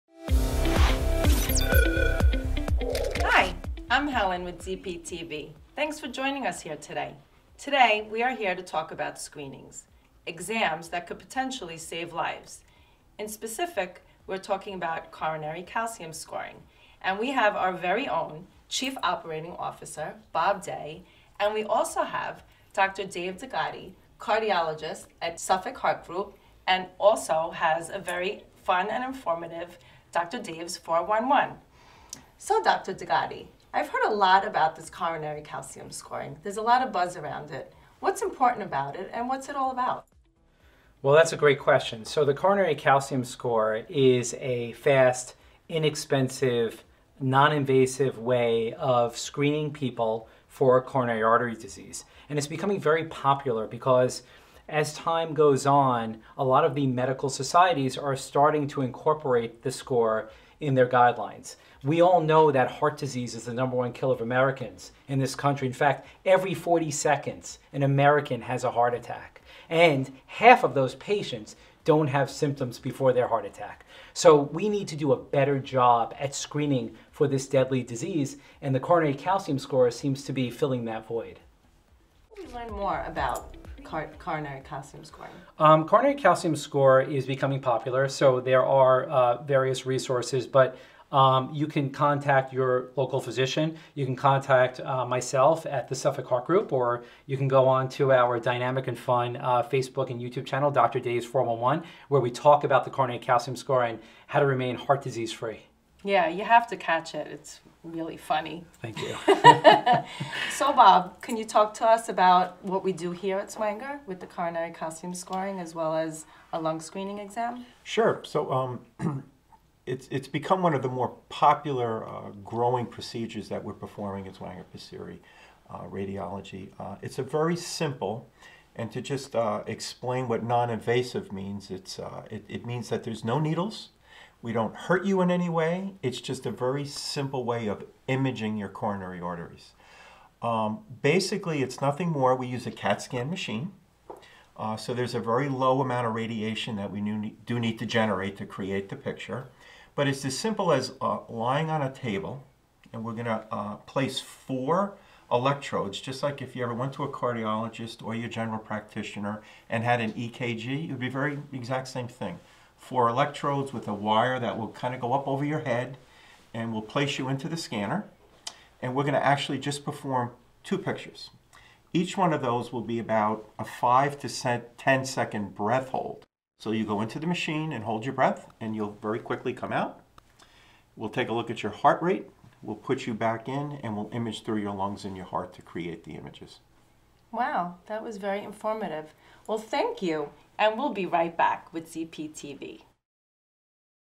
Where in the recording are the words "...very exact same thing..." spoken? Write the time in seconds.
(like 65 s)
161 s.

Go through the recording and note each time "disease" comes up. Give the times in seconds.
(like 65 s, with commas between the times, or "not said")
51 s, 62 s, 77 s, 105 s.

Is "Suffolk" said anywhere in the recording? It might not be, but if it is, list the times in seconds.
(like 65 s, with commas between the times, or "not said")
25 s, 95 s.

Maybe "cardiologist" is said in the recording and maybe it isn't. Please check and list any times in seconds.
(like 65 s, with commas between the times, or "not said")
24 s, 157 s.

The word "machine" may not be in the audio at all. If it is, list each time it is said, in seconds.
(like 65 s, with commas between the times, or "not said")
143 s, 177 s.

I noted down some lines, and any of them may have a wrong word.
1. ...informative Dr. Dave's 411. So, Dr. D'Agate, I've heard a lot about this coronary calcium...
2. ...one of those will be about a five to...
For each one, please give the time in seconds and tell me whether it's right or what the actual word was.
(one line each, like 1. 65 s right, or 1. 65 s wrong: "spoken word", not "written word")
1. 29 s right
2. 172 s right.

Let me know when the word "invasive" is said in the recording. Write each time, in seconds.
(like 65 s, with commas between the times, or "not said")
47 s, 130 s.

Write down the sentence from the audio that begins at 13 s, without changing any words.
In specific, we're talking about coronary calcium scoring.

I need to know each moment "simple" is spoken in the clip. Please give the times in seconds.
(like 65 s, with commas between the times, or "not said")
127 s, 136 s, 150 s.